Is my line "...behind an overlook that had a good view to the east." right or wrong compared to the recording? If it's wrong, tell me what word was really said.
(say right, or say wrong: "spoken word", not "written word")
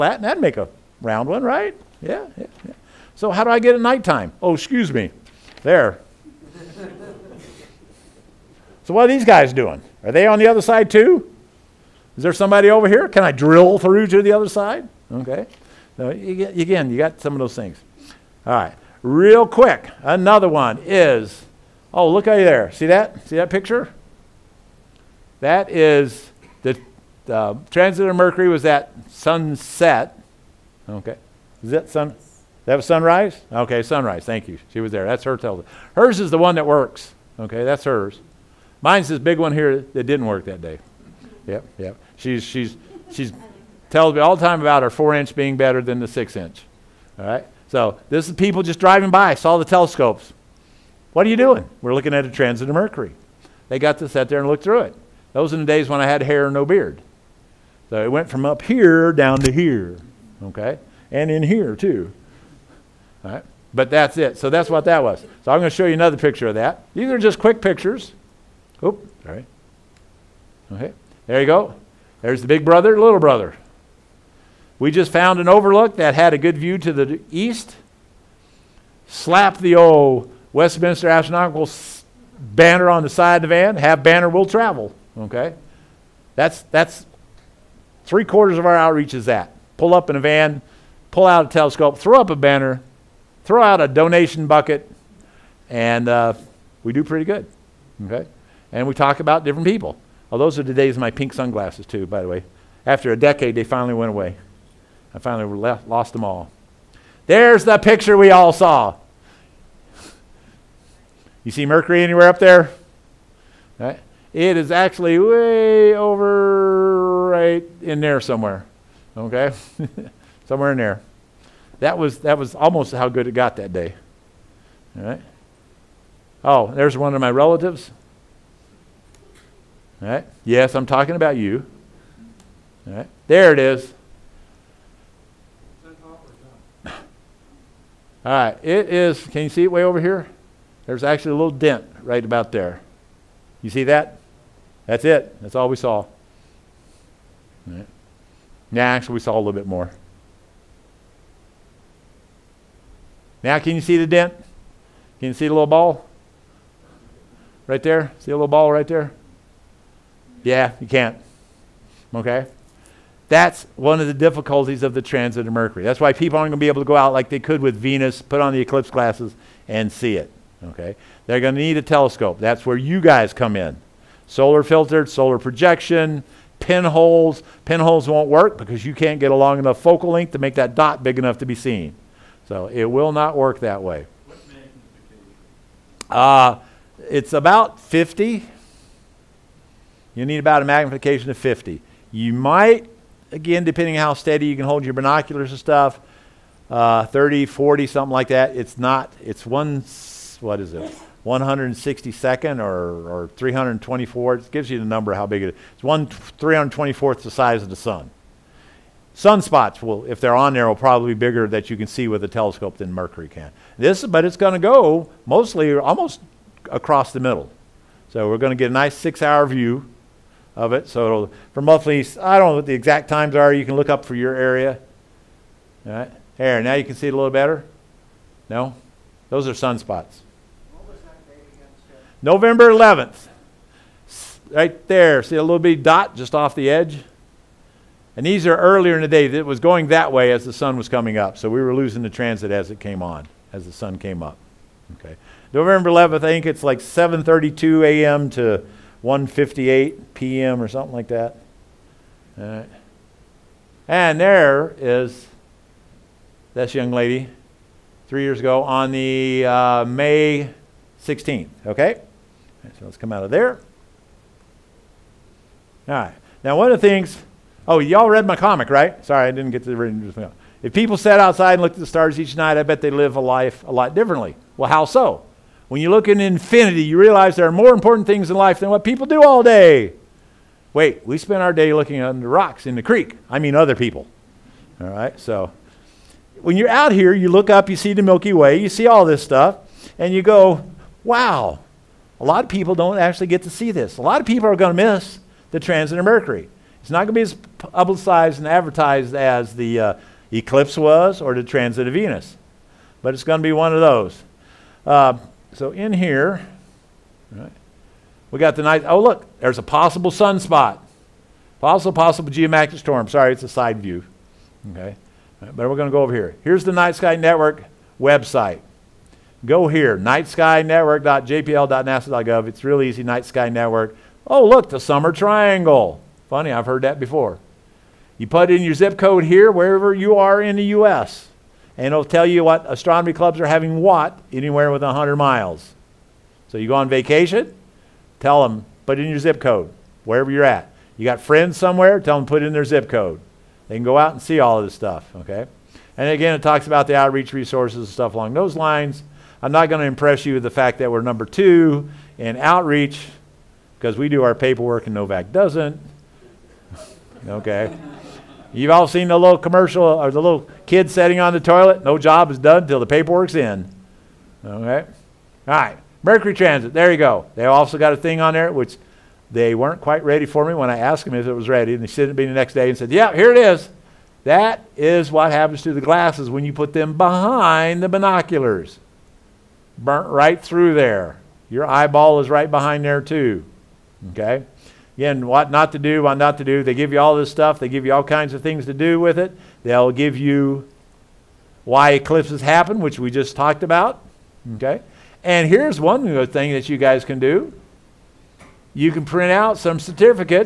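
wrong: "found", not "behind".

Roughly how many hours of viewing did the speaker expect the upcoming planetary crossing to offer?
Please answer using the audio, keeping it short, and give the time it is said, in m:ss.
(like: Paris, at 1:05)
6, at 3:38.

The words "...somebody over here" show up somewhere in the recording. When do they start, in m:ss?
0:12.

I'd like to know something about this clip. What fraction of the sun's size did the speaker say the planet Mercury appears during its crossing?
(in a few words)
1/324.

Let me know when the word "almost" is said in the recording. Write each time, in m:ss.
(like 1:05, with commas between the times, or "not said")
2:02, 3:35.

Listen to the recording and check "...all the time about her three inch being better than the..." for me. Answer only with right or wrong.
wrong.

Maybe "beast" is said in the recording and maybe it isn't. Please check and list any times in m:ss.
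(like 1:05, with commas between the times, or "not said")
not said.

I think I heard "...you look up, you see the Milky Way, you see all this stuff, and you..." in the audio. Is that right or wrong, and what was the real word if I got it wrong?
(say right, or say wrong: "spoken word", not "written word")
right.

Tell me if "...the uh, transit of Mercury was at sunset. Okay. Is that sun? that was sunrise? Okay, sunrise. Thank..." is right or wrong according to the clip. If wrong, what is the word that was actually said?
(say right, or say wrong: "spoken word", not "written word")
right.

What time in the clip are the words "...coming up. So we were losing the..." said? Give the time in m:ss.
4:00.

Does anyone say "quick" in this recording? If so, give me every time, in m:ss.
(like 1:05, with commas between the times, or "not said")
0:19, 1:07.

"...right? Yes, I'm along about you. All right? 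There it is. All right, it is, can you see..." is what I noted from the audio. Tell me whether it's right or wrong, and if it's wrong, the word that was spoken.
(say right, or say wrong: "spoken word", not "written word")
wrong: "talking", not "along".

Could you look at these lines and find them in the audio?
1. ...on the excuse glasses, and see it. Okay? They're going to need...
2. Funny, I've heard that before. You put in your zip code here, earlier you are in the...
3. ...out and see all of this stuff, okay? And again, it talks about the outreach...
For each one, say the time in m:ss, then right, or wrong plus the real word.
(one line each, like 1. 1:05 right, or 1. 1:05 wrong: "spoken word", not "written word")
1. 2:48 wrong: "eclipse", not "excuse"
2. 5:26 wrong: "wherever", not "earlier"
3. 5:43 right.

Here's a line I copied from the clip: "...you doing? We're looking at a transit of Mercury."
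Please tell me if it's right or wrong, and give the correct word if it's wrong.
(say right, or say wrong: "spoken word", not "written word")
right.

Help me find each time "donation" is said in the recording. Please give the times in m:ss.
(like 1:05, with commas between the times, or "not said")
1:33.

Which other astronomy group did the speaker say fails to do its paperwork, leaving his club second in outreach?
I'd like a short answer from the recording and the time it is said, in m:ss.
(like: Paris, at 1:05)
NOVAC, at 5:54.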